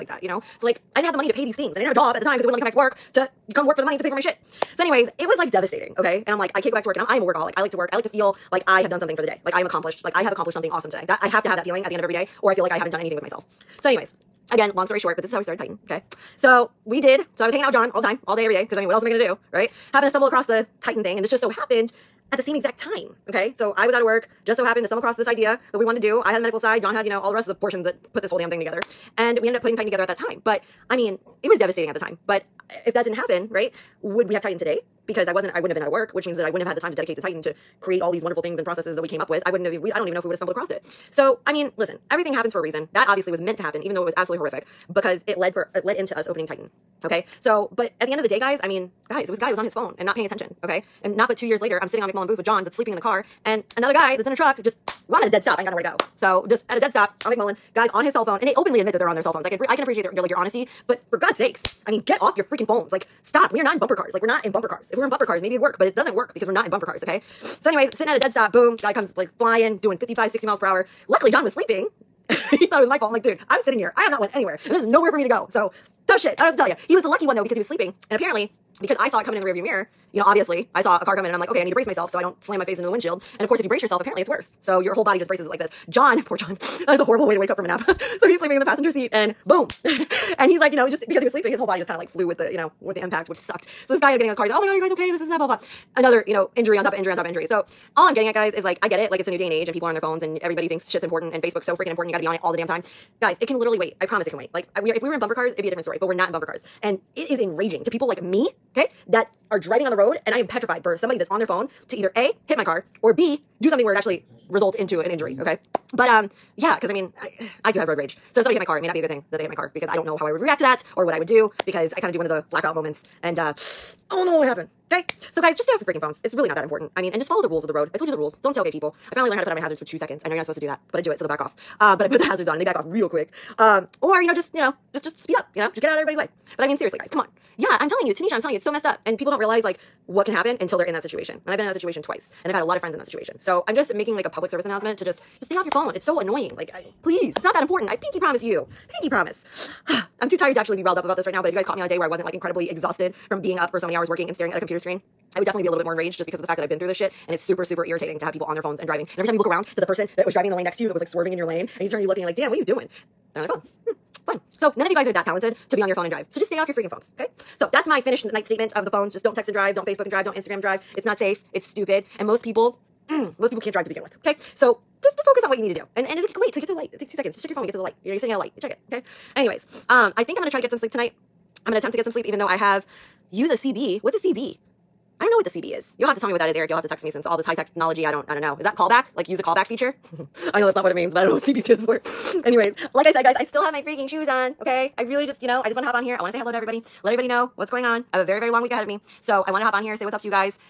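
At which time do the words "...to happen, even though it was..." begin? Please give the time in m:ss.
0:43.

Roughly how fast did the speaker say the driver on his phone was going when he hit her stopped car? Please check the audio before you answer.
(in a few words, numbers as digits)
55 to 60 mph.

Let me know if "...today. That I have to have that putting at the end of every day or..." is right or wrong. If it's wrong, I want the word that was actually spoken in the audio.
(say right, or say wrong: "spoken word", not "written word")
wrong: "feeling", not "putting".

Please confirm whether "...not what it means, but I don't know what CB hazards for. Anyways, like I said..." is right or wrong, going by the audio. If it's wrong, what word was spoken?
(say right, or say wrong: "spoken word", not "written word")
wrong: "stands", not "hazards".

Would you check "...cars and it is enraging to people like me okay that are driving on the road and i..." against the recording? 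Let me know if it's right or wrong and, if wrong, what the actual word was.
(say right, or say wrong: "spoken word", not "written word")
right.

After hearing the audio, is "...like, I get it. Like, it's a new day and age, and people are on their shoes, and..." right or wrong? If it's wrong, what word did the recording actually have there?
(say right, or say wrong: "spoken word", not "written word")
wrong: "phones", not "shoes".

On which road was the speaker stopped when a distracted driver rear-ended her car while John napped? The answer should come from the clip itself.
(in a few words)
McMullen Booth.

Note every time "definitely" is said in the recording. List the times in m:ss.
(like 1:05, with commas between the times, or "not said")
2:35.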